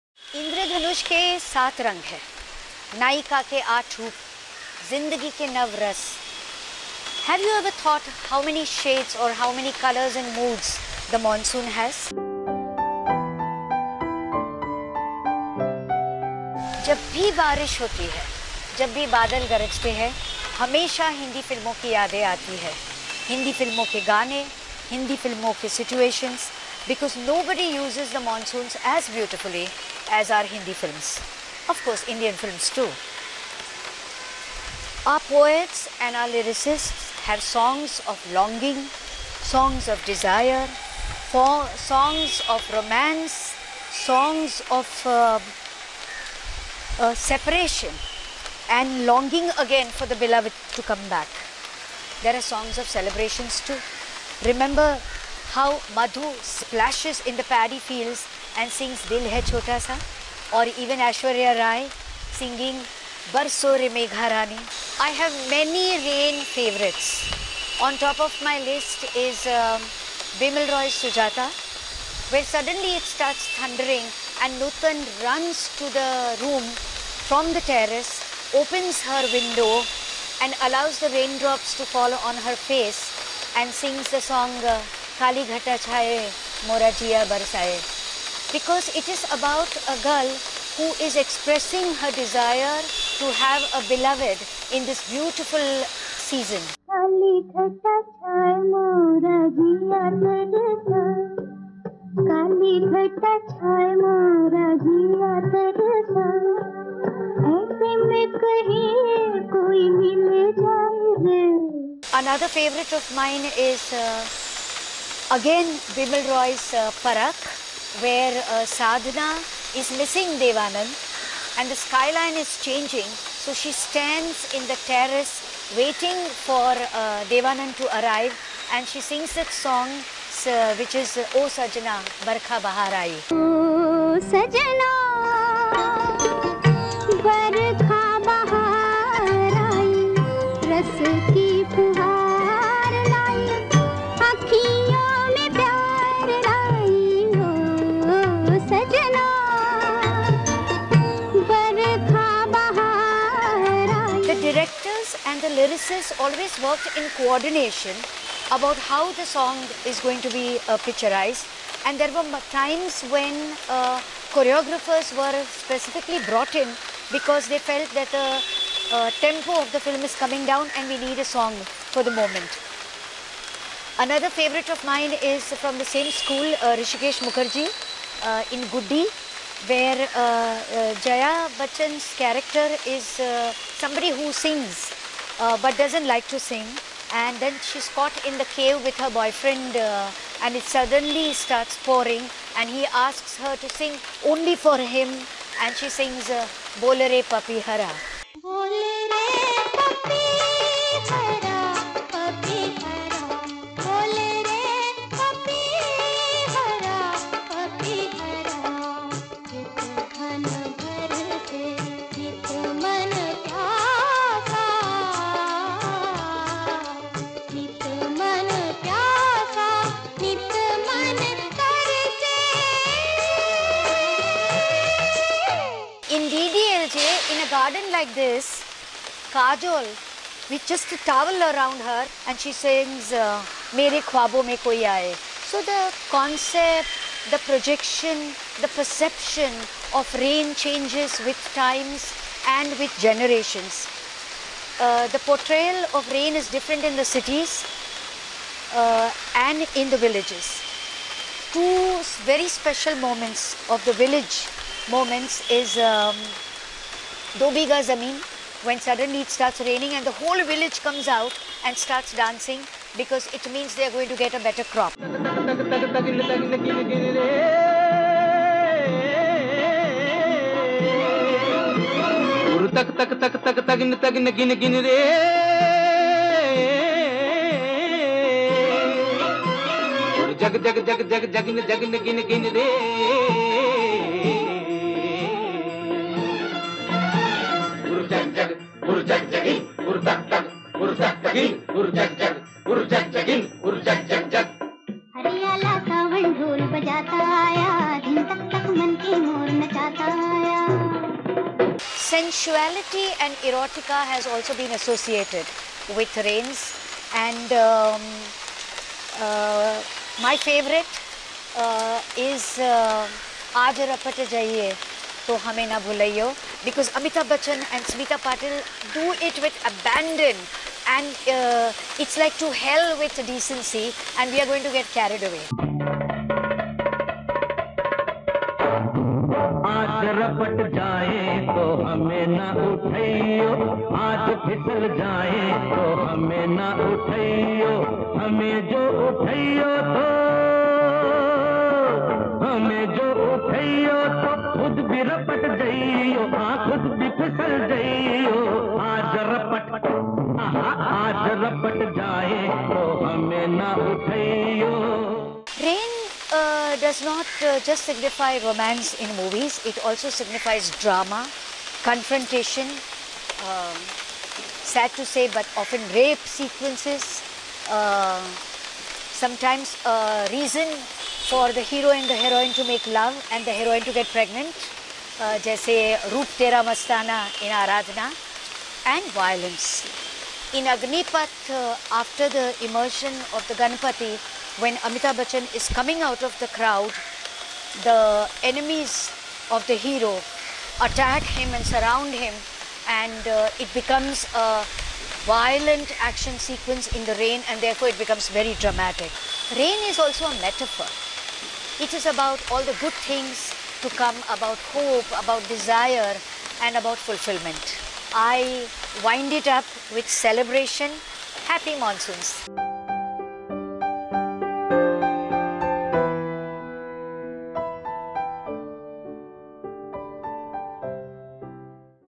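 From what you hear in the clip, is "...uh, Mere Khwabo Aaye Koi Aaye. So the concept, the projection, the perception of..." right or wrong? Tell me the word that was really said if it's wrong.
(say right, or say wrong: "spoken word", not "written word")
wrong: "Mein", not "Aaye".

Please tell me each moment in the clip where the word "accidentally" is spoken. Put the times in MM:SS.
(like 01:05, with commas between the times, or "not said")
not said.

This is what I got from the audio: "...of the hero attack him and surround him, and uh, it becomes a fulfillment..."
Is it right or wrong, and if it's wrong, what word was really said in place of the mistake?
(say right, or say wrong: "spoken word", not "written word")
wrong: "violent", not "fulfillment".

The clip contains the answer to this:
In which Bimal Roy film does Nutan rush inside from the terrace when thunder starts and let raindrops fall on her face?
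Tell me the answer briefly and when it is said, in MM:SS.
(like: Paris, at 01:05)
Sujata, at 01:11.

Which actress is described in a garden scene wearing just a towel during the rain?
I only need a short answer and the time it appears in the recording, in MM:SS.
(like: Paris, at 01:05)
Kajol, at 03:49.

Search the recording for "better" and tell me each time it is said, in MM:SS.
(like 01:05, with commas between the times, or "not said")
04:24.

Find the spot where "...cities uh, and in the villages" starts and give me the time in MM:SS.
04:07.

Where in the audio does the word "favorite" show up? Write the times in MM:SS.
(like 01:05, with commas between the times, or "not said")
01:06, 01:52, 02:54.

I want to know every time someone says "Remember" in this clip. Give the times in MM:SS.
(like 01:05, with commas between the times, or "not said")
00:54.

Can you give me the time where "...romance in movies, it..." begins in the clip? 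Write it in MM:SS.
05:58.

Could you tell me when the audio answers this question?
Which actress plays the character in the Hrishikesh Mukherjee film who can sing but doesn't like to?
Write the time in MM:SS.
03:01.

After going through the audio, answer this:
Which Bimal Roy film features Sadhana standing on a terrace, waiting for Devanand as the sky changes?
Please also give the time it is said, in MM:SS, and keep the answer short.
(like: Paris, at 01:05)
Parakh, at 01:57.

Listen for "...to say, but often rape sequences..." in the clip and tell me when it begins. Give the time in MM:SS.
06:04.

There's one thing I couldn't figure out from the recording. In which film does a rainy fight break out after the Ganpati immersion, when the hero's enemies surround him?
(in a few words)
Agnipath.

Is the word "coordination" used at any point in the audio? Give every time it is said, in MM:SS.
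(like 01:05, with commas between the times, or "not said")
02:37.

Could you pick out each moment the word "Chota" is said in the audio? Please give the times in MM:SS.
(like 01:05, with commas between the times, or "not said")
00:59.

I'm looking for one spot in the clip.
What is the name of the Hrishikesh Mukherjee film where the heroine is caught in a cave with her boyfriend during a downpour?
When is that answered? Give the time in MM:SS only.
02:58.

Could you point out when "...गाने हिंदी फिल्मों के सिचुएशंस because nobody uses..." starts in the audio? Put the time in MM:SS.
00:24.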